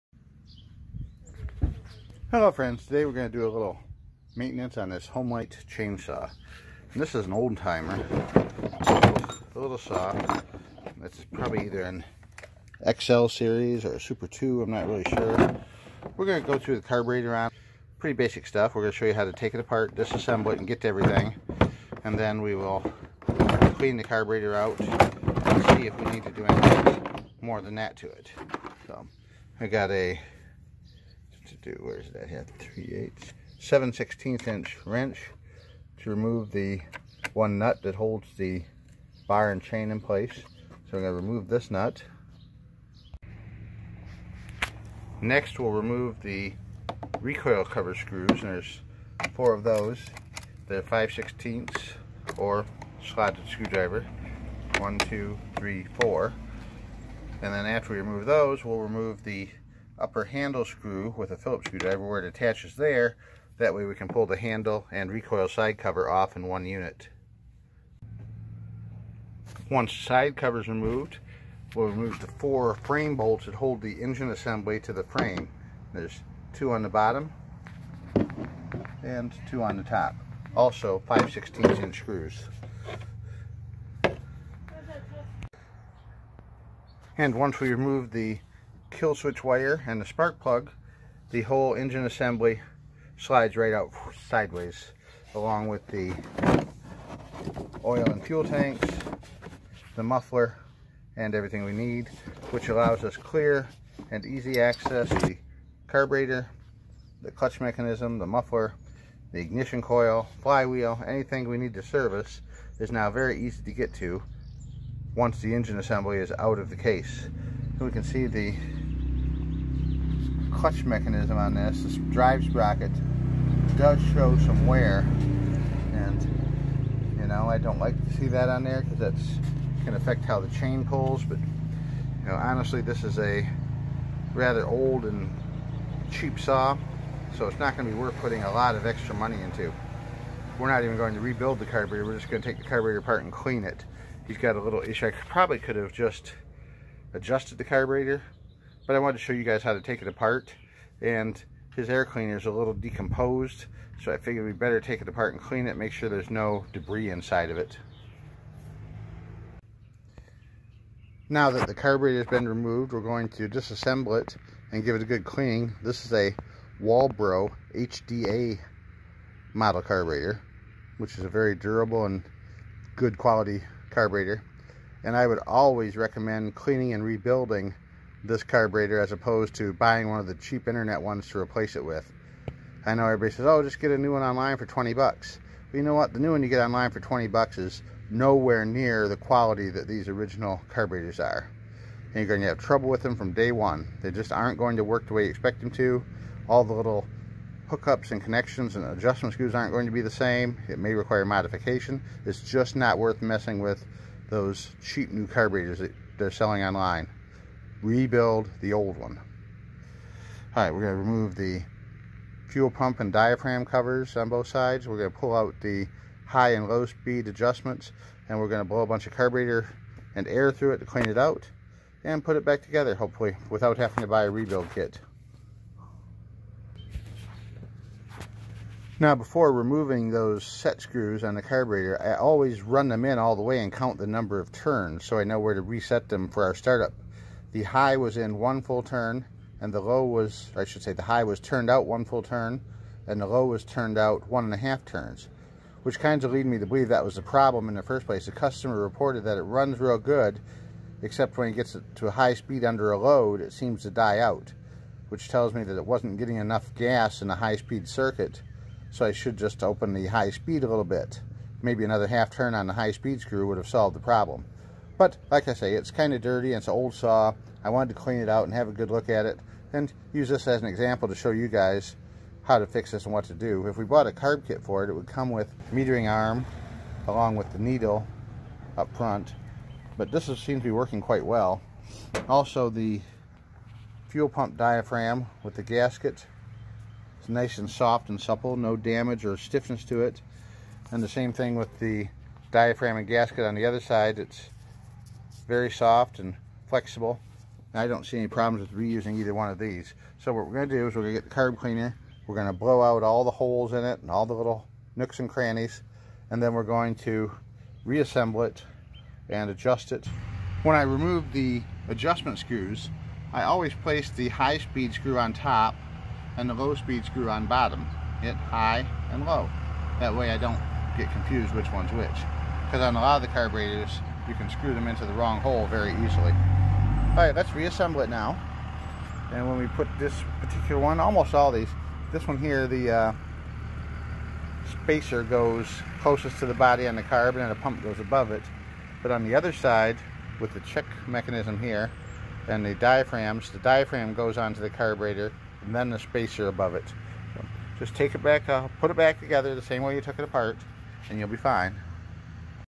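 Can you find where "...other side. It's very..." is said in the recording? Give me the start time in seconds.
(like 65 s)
293 s.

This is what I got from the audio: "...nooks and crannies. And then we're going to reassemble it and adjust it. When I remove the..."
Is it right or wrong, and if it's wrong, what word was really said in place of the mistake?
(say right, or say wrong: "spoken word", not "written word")
right.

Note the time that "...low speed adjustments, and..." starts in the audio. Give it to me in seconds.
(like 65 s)
216 s.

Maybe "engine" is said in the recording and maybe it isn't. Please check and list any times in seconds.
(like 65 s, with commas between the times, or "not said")
74 s, 91 s, 115 s.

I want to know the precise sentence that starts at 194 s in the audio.
They just aren't going to work the way you expect them to.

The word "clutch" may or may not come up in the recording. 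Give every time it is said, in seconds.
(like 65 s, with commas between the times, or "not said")
107 s, 120 s.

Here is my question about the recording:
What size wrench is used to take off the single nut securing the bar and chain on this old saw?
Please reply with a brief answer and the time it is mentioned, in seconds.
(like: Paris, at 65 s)
7/16 inch, at 33 s.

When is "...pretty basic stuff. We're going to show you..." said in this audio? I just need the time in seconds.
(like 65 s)
17 s.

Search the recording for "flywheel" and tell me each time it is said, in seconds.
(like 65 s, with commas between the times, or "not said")
110 s.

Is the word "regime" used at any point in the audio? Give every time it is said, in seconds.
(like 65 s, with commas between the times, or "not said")
not said.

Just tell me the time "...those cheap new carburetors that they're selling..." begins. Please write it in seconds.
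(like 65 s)
204 s.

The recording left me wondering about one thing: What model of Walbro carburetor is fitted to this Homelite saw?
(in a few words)
HDA.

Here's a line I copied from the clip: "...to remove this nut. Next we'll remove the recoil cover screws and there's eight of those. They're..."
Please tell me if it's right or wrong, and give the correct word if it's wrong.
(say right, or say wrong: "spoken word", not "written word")
wrong: "four", not "eight".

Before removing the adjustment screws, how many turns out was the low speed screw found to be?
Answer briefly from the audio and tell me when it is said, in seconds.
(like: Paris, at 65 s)
1.5 turns, at 244 s.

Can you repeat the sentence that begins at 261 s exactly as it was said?
Maybe another half turn on the high speed screw would have solved the problem.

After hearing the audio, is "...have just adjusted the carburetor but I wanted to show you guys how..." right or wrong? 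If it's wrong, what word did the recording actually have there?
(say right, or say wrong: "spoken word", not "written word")
right.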